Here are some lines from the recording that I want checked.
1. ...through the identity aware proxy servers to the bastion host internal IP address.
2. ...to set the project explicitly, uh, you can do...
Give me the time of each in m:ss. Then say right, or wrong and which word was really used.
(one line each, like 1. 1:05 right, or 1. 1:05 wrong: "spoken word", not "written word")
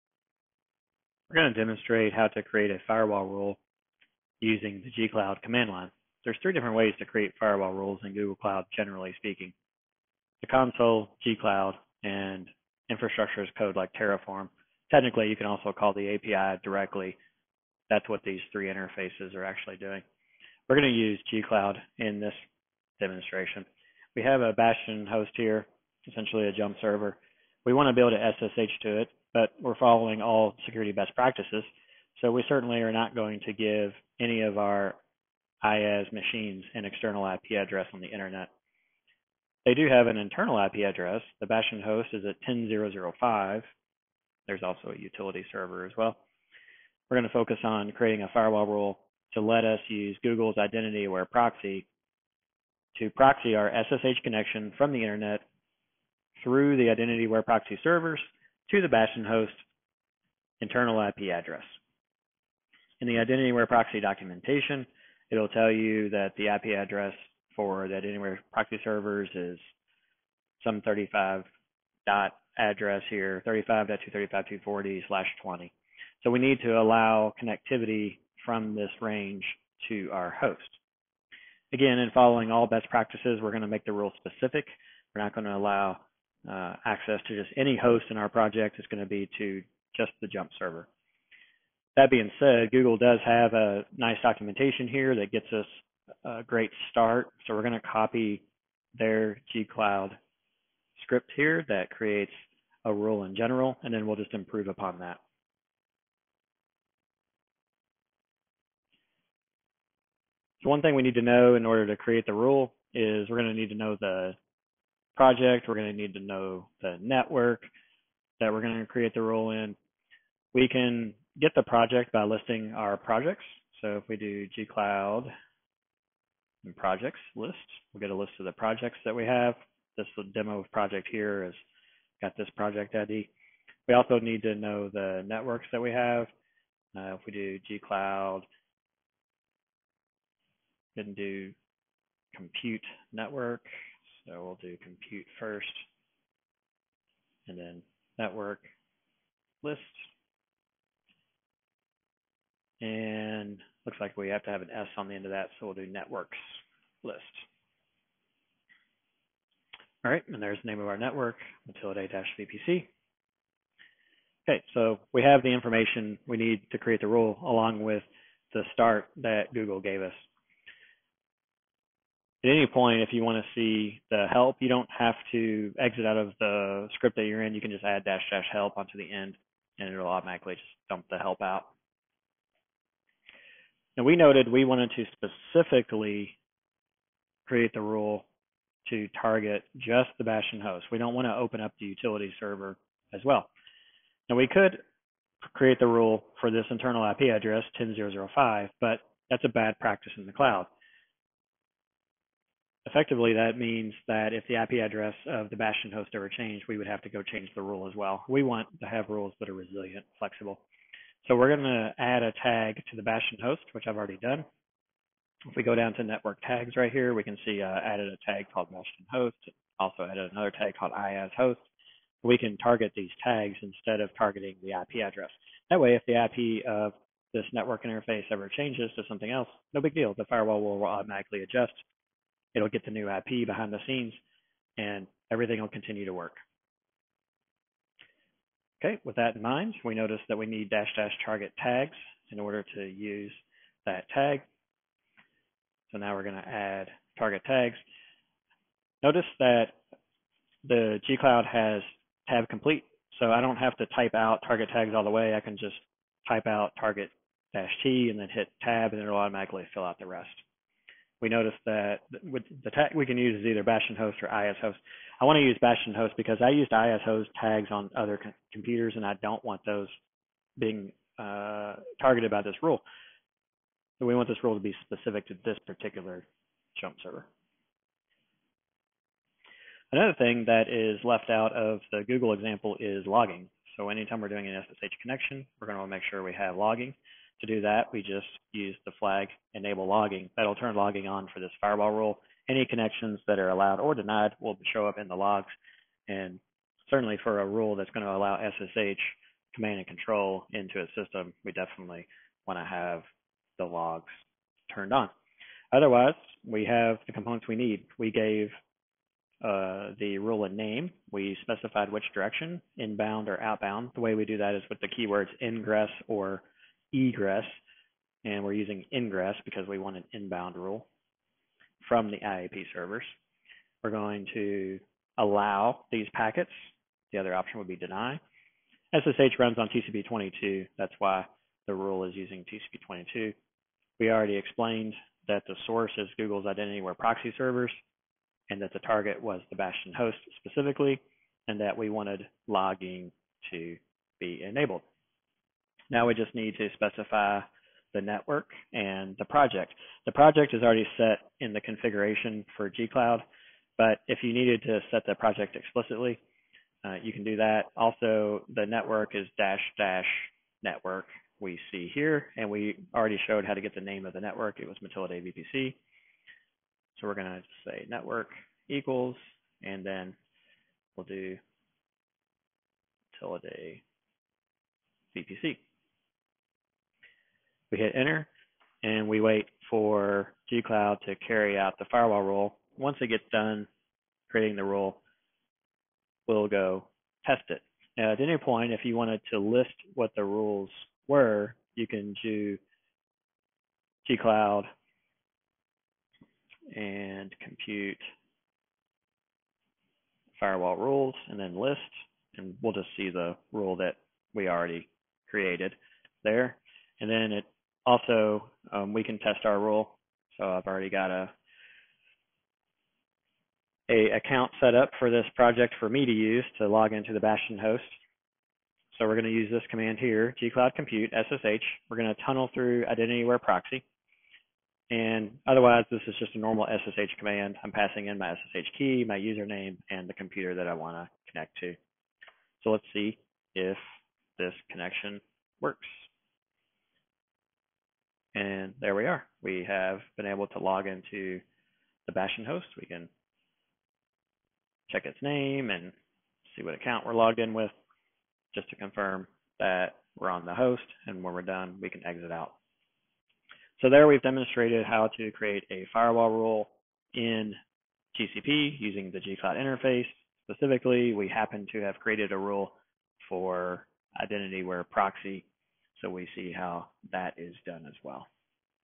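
1. 0:56 right
2. 5:54 right.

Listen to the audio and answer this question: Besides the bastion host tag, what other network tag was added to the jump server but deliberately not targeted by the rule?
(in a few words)
IAS host.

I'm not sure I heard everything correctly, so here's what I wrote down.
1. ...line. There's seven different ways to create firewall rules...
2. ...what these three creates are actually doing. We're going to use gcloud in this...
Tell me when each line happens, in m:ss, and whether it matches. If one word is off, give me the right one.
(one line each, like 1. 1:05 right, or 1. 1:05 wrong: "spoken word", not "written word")
1. 0:05 wrong: "three", not "seven"
2. 0:18 wrong: "interfaces", not "creates".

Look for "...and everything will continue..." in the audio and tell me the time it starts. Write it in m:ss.
3:54.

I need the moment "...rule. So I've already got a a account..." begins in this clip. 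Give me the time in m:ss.
6:49.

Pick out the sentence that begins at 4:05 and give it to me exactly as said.
So now we're gonna add target tags.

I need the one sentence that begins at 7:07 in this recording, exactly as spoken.
I'm passing in my SSH key, my username, and the computer that I want to connect to.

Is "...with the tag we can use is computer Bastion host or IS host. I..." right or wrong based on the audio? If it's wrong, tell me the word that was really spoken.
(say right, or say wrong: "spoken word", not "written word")
wrong: "either", not "computer".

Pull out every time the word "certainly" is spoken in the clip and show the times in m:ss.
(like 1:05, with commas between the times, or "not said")
0:32, 4:56.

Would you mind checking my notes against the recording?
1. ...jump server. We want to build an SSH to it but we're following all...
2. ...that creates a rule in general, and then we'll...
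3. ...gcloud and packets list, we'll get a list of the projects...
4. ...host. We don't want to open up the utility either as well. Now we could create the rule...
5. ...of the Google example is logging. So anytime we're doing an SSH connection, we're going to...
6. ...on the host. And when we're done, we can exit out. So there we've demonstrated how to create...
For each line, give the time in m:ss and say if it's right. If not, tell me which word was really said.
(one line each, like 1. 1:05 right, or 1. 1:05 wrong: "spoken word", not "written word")
1. 0:26 right
2. 1:41 right
3. 2:04 wrong: "projects", not "packets"
4. 3:10 wrong: "server", not "either"
5. 4:41 right
6. 7:30 right.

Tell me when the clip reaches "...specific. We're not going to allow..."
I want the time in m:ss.
1:24.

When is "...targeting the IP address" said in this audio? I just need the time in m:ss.
3:44.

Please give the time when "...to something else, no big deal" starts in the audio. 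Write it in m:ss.
3:48.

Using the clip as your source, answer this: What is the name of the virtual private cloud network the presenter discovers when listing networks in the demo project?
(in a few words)
Matilda-VPC.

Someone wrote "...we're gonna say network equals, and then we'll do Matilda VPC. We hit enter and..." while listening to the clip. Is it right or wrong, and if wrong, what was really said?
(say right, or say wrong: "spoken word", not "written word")
right.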